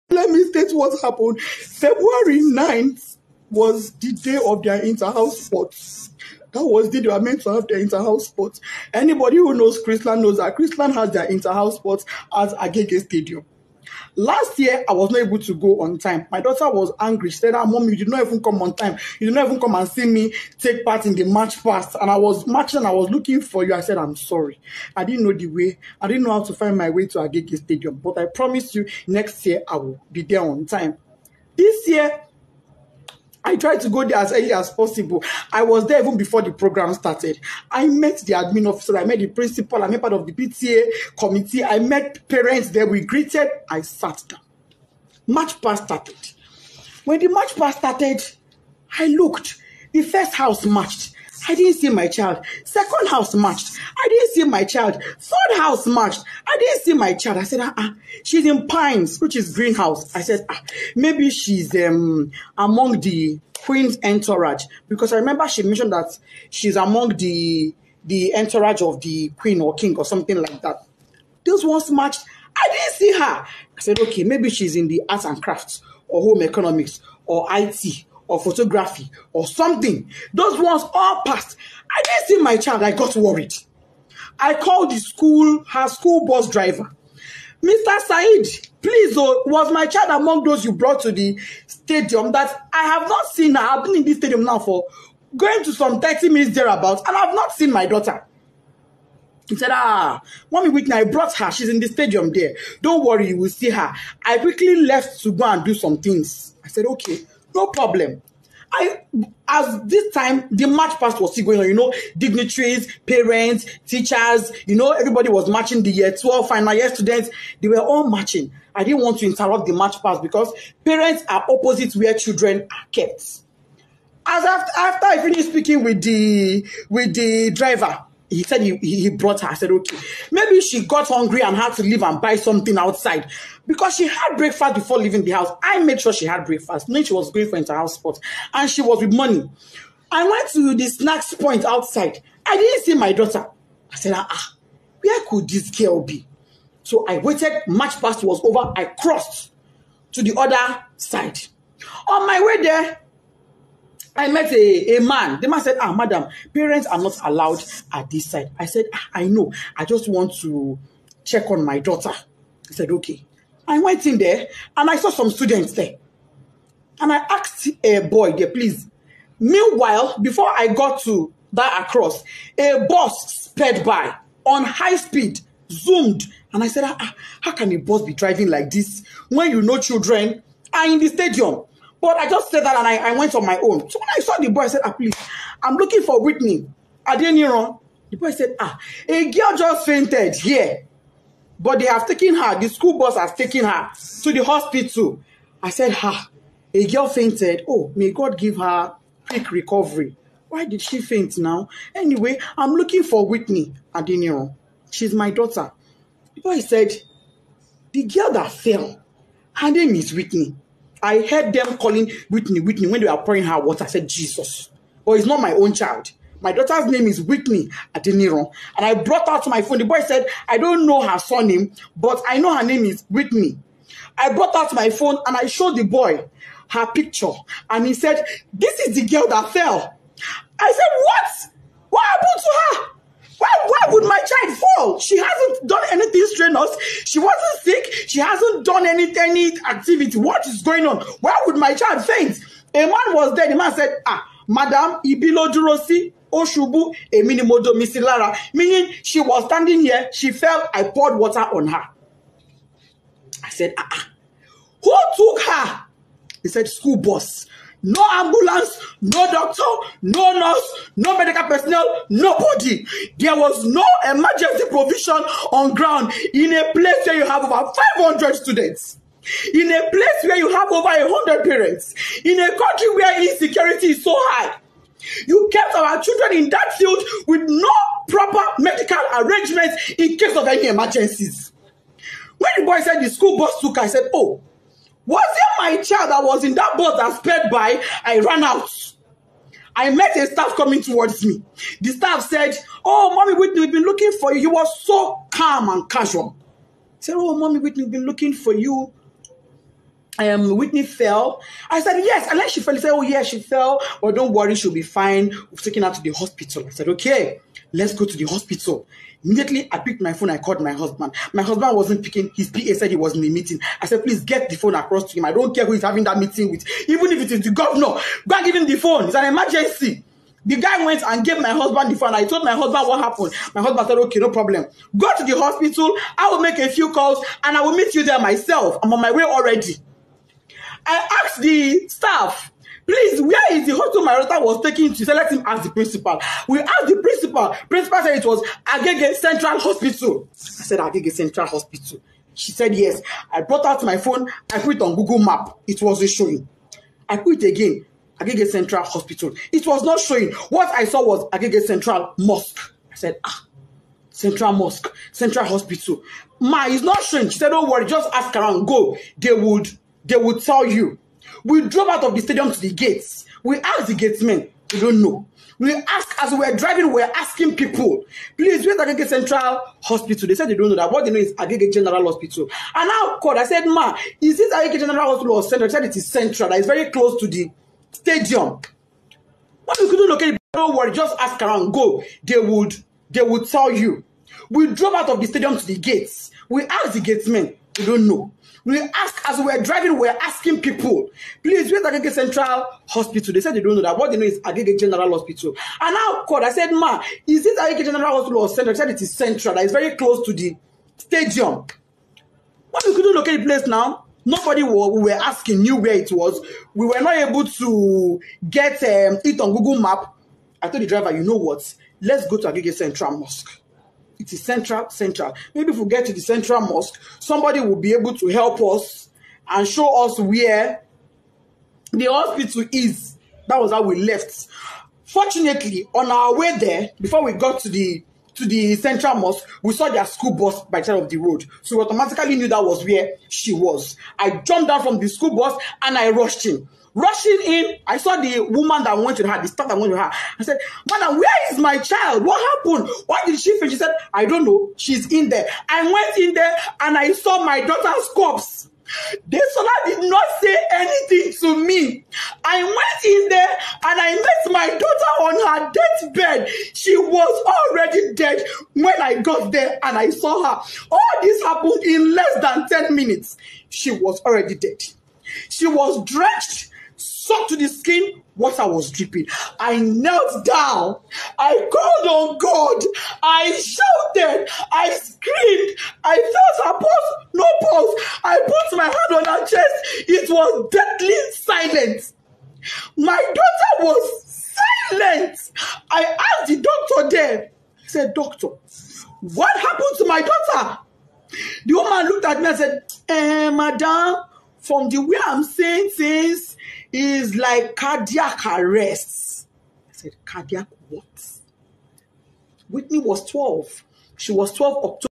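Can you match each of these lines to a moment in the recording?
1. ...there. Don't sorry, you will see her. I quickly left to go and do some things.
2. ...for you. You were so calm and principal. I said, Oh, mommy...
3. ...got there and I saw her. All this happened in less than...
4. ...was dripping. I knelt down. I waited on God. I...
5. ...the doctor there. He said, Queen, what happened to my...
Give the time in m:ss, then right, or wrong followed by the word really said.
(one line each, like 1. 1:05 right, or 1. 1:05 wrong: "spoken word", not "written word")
1. 1:42 wrong: "worry", not "sorry"
2. 4:54 wrong: "casual", not "principal"
3. 7:39 right
4. 7:48 wrong: "called", not "waited"
5. 8:06 wrong: "Doctor", not "Queen".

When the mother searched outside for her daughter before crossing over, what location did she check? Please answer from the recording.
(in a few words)
the snacks point.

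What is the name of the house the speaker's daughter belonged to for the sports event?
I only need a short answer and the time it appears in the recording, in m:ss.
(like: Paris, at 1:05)
Pines, at 0:58.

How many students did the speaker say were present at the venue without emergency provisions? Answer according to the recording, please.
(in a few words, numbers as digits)
over 500.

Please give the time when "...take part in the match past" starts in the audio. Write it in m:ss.
0:20.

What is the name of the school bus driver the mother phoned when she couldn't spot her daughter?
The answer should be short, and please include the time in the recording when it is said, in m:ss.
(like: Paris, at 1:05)
Mr. Said, at 1:27.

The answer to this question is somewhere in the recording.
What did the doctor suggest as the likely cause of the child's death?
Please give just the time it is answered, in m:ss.
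8:17.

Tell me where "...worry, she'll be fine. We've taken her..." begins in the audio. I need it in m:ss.
5:04.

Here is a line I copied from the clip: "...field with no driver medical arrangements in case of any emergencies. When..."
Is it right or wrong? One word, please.
wrong.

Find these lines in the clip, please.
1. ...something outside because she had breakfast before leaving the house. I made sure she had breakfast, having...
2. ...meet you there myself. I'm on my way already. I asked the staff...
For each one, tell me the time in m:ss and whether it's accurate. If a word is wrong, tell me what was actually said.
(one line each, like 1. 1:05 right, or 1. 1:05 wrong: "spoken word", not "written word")
1. 2:12 wrong: "knowing", not "having"
2. 5:27 right.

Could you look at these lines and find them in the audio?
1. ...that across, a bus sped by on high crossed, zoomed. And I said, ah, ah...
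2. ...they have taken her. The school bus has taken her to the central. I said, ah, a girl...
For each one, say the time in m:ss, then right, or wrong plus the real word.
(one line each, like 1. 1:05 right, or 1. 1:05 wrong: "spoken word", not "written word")
1. 2:51 wrong: "speed", not "crossed"
2. 3:11 wrong: "hospital", not "central".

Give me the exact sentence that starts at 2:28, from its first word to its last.
I crossed to the other side.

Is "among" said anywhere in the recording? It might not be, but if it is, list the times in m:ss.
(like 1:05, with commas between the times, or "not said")
1:02, 1:06, 1:30.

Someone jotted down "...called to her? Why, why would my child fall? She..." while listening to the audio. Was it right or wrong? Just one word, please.
wrong.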